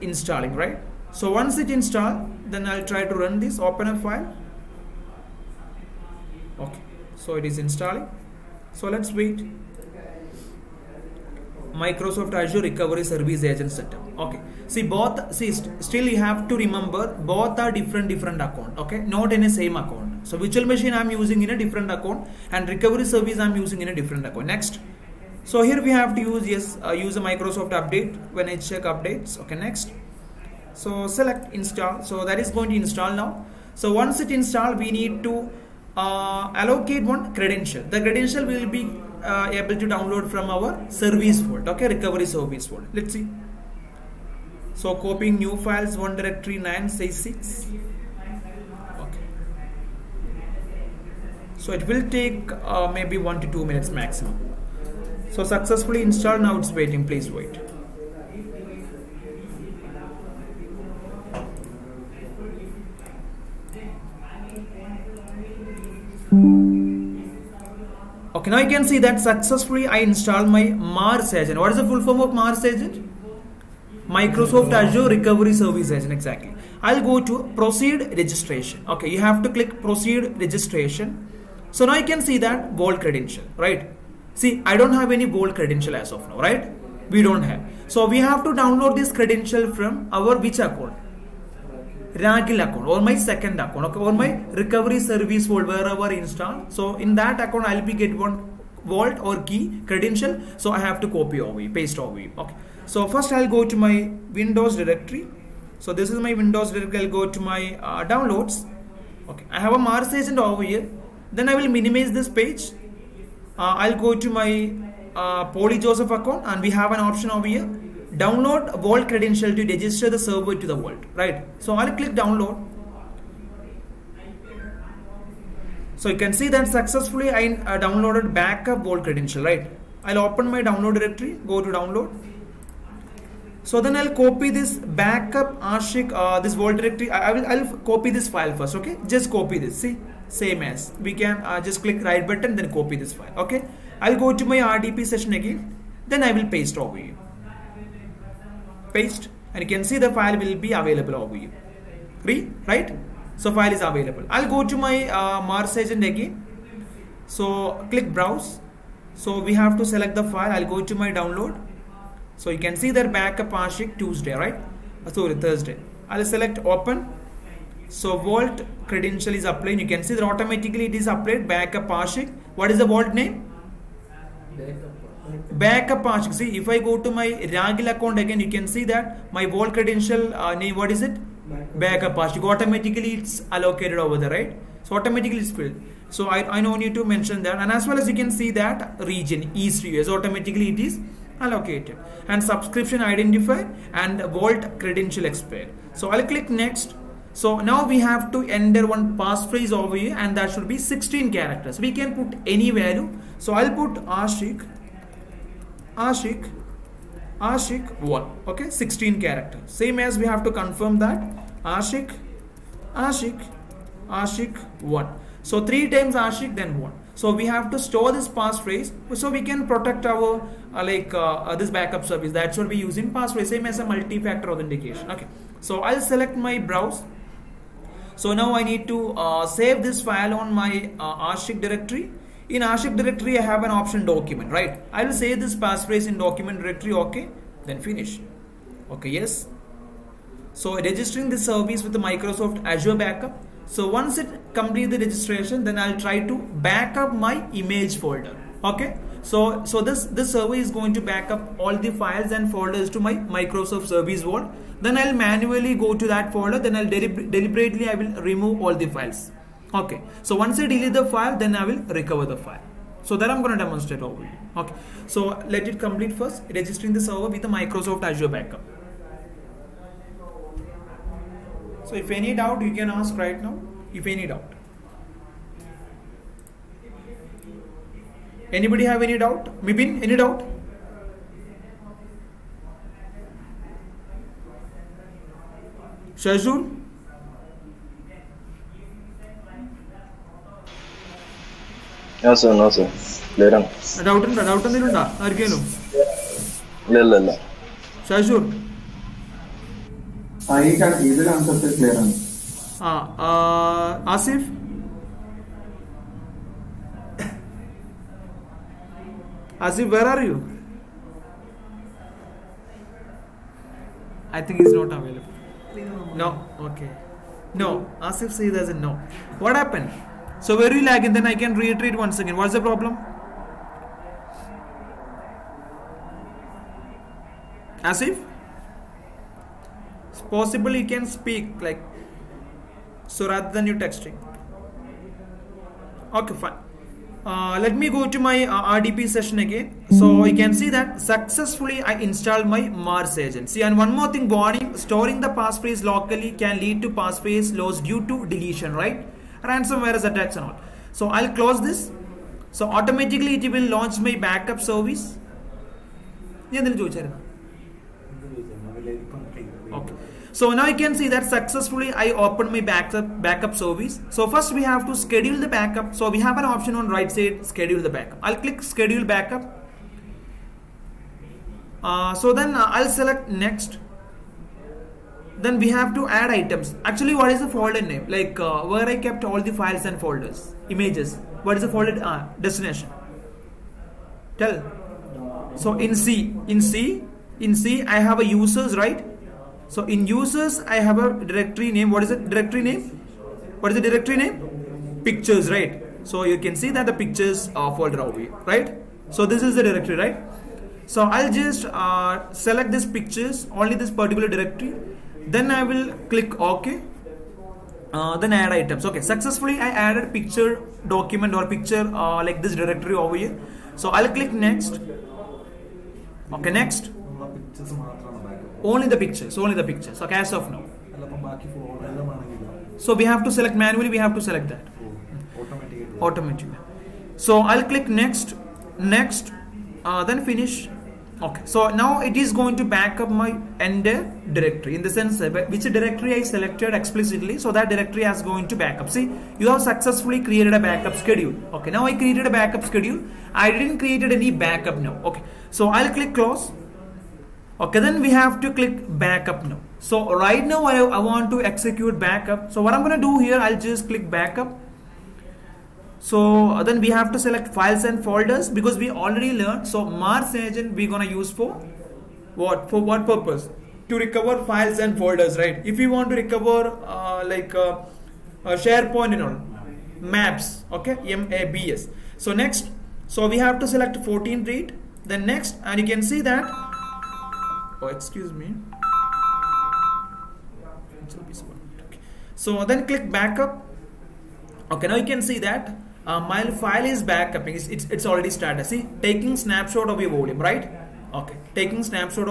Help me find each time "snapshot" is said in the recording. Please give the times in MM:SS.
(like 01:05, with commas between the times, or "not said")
08:09.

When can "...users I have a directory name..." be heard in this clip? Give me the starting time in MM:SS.
06:30.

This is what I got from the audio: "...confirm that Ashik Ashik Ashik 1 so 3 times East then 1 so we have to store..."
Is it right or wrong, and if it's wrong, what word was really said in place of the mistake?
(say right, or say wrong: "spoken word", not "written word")
wrong: "Ashik", not "East".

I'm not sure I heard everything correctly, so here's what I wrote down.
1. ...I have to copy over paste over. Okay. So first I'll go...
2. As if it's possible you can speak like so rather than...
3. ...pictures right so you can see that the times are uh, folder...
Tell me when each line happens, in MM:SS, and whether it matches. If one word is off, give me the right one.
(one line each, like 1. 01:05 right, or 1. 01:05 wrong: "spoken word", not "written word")
1. 01:40 right
2. 05:27 right
3. 06:35 wrong: "pictures", not "times".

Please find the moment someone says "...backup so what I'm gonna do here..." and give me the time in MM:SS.
07:31.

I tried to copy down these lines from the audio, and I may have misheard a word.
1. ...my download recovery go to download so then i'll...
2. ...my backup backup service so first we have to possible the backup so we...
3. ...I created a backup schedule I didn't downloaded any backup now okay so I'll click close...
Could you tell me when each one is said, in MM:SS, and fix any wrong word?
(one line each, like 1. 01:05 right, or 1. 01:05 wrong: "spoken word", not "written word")
1. 02:10 wrong: "directory", not "recovery"
2. 06:02 wrong: "schedule", not "possible"
3. 07:21 wrong: "created", not "downloaded".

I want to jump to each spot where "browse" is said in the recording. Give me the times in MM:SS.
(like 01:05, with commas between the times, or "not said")
02:38, 03:46.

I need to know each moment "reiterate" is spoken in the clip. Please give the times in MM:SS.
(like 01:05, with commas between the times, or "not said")
05:21.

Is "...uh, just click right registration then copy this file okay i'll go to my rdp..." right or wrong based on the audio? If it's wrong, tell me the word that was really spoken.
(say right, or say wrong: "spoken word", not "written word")
wrong: "button", not "registration".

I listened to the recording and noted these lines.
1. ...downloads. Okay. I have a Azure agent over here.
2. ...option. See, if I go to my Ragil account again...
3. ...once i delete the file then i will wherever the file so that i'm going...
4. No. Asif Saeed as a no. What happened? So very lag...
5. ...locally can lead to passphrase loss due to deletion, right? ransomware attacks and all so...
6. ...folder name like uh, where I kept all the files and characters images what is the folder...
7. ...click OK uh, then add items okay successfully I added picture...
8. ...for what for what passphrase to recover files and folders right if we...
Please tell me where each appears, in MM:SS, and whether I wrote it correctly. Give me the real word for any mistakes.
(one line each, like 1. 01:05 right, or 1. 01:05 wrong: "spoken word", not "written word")
1. 01:48 wrong: "Mars", not "Azure"
2. 02:56 right
3. 04:20 wrong: "recover", not "wherever"
4. 05:17 right
5. 05:45 right
6. 06:17 wrong: "folders", not "characters"
7. 06:46 right
8. 07:41 wrong: "purpose", not "passphrase".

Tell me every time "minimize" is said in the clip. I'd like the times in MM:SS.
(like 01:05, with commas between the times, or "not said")
01:51.